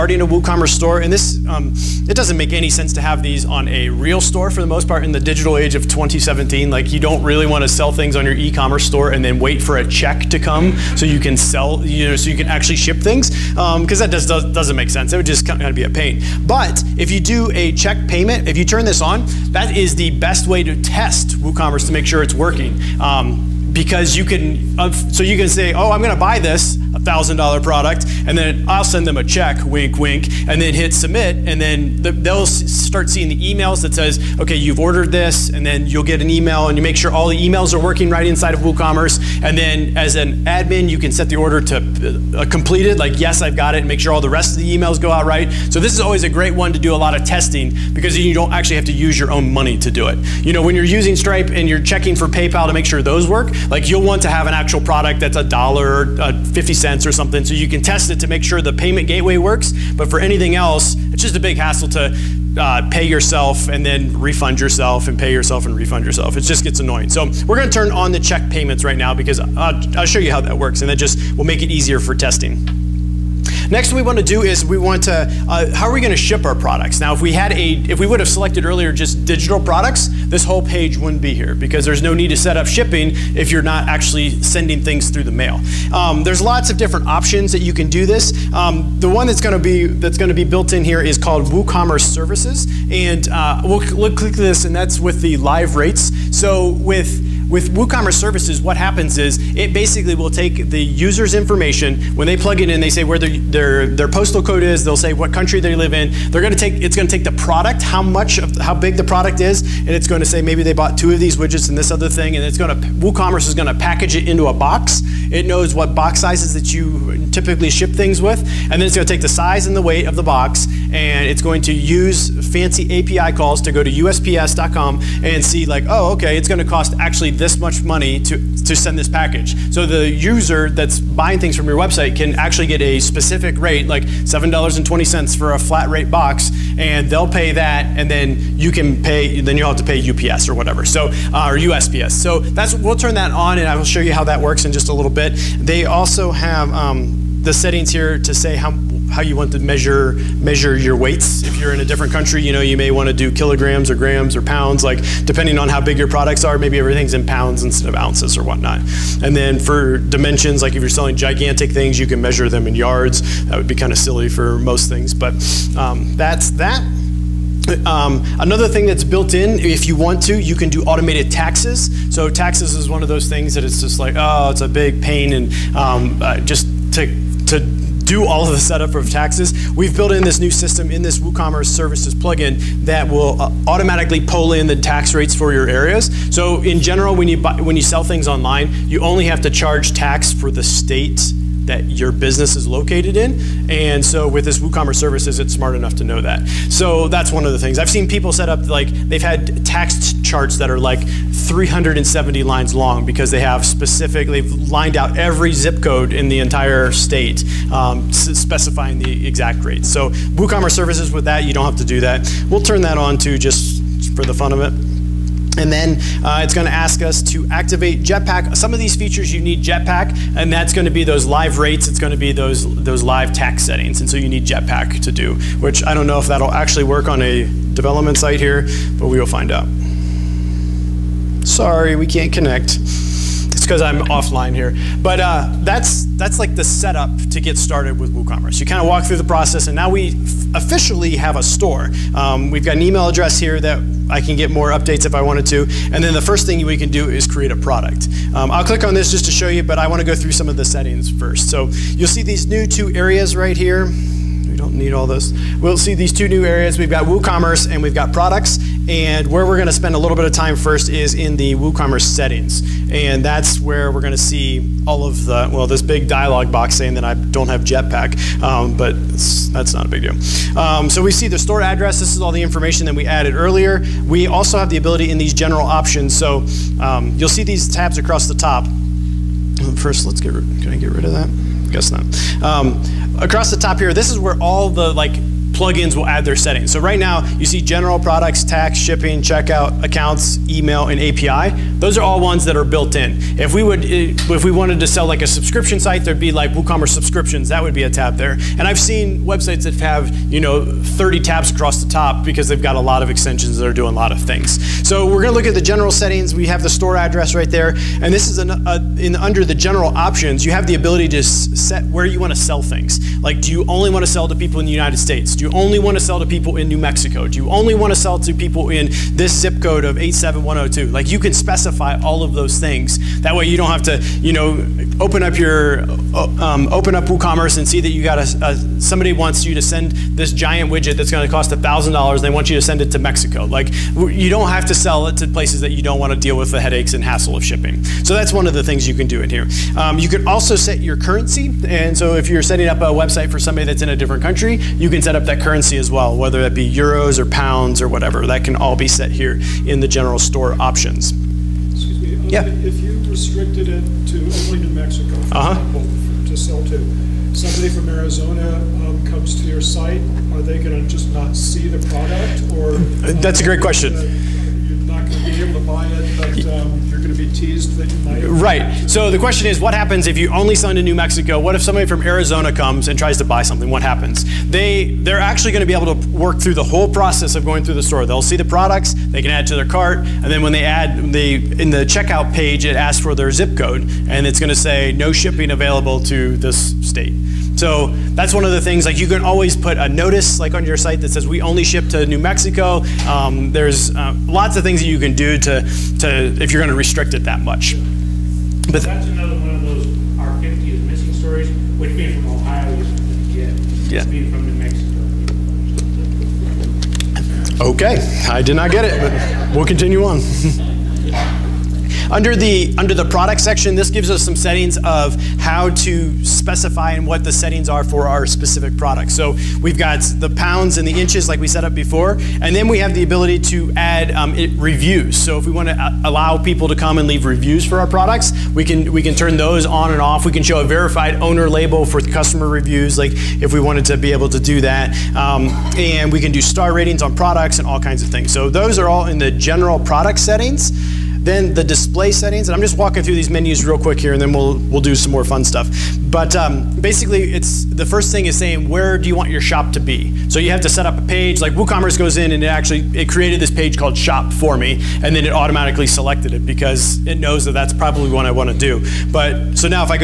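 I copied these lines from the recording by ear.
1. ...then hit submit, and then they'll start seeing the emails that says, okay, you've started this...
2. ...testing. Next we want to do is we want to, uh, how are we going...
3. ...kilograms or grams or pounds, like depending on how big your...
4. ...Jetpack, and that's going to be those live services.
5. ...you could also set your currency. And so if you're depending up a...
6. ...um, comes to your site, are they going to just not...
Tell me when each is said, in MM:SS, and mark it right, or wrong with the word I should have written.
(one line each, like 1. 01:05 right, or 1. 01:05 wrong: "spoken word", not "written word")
1. 00:30 wrong: "ordered", not "started"
2. 01:12 right
3. 02:33 right
4. 03:39 wrong: "rates", not "services"
5. 05:39 wrong: "setting", not "depending"
6. 05:58 right.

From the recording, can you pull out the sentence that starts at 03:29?
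So WooCommerce services with that, you don't have to do that.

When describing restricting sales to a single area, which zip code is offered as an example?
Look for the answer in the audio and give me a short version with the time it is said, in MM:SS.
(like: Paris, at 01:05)
87102, at 05:19.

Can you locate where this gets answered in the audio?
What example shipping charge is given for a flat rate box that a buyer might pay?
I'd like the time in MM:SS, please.
02:14.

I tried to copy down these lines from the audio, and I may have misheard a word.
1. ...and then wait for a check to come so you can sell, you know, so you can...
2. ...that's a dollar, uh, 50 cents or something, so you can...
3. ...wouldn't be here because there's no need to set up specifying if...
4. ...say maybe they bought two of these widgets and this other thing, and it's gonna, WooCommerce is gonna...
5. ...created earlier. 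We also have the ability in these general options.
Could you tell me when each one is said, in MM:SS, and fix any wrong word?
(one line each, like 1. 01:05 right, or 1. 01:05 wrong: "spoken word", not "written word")
1. 00:09 right
2. 00:55 right
3. 01:20 wrong: "shipping", not "specifying"
4. 01:50 right
5. 04:33 wrong: "added", not "created".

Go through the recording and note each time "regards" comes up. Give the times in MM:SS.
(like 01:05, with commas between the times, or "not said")
not said.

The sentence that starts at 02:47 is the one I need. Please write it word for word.
Um, another thing that's built in, if you want to, you can do automated taxes.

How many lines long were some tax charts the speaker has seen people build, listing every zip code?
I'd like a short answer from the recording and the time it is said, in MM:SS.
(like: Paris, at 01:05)
370, at 03:21.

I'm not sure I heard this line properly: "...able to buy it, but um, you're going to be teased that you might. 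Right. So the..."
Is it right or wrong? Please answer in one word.
right.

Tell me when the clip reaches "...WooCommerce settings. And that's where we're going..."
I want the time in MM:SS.
04:21.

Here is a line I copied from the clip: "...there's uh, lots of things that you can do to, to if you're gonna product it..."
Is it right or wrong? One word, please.
wrong.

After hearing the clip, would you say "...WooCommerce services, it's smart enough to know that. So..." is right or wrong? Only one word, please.
right.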